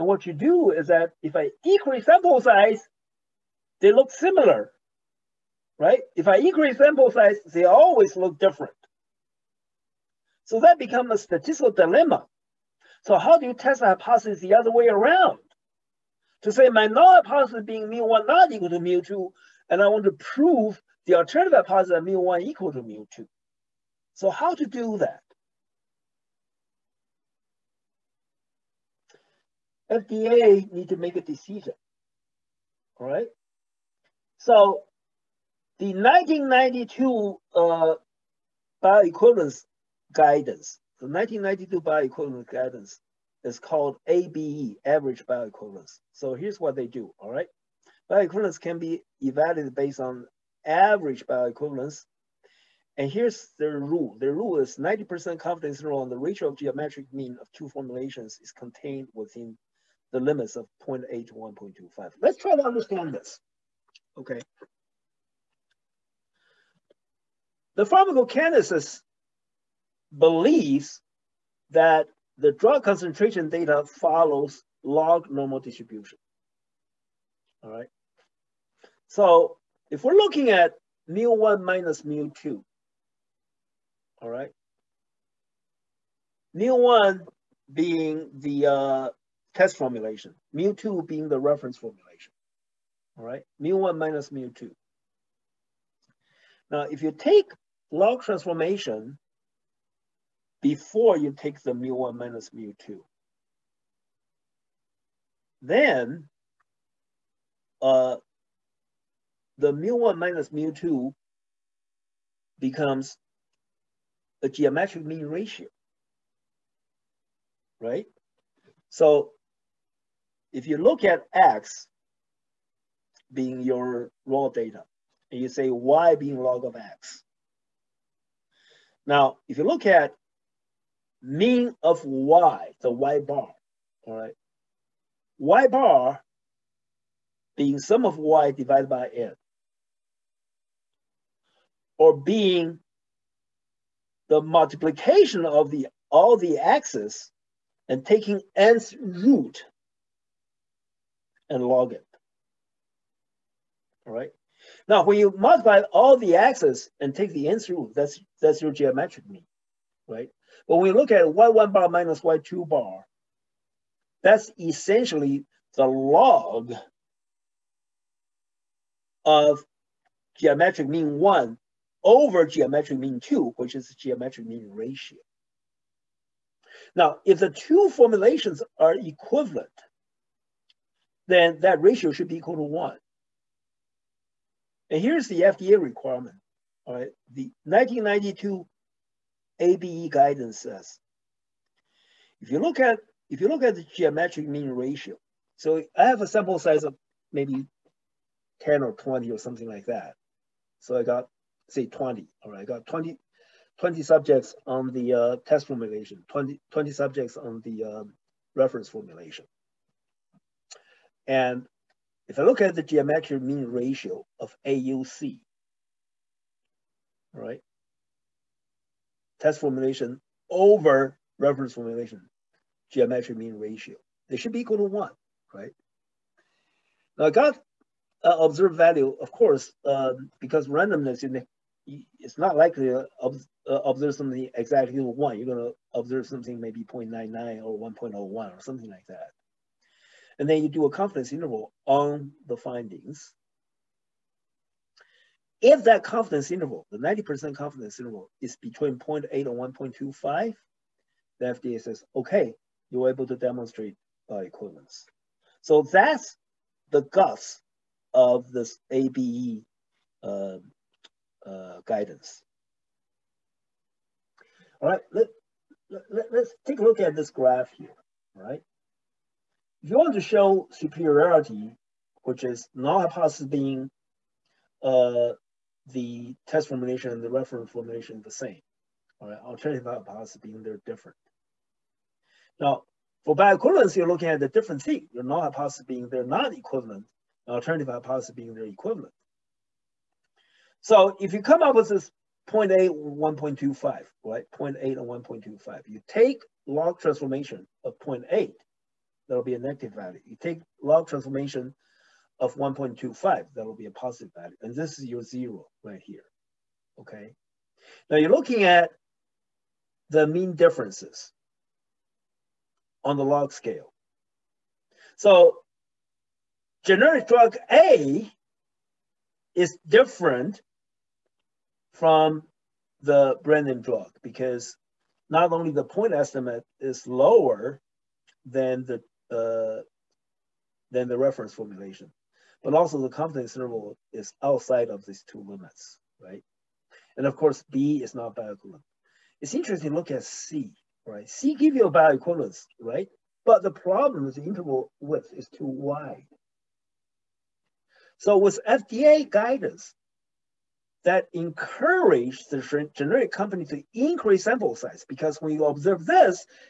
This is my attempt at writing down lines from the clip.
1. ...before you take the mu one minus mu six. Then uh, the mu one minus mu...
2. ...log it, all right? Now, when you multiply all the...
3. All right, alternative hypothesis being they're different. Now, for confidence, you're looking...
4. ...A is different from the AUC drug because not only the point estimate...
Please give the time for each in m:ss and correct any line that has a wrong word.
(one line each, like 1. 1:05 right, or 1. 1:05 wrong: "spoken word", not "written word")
1. 1:40 wrong: "two", not "six"
2. 2:31 right
3. 4:39 wrong: "bioequivalence", not "confidence"
4. 5:17 wrong: "Brennan", not "AUC".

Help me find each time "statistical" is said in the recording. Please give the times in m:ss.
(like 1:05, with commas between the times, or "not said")
0:11.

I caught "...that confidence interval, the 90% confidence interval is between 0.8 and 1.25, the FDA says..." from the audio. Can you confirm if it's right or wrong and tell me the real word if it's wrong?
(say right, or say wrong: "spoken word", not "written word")
right.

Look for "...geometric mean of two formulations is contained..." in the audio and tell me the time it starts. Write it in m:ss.
0:56.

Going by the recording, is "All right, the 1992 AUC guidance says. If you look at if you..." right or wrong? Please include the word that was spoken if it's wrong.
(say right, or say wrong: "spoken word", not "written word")
wrong: "ABE", not "AUC".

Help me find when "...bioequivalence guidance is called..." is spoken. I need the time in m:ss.
0:41.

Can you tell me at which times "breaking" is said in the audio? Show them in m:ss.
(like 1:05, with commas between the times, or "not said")
not said.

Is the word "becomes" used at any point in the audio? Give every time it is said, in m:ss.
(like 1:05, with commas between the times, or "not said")
0:10, 1:52.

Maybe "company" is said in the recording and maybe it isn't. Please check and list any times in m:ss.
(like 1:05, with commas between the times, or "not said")
5:53.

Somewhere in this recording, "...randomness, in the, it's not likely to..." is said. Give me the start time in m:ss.
3:50.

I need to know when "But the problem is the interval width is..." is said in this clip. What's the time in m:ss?
5:43.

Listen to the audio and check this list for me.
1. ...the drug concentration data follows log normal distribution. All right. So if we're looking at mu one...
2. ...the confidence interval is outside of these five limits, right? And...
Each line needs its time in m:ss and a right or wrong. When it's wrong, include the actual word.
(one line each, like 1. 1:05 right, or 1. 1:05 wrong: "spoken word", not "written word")
1. 1:12 right
2. 5:32 wrong: "two", not "five".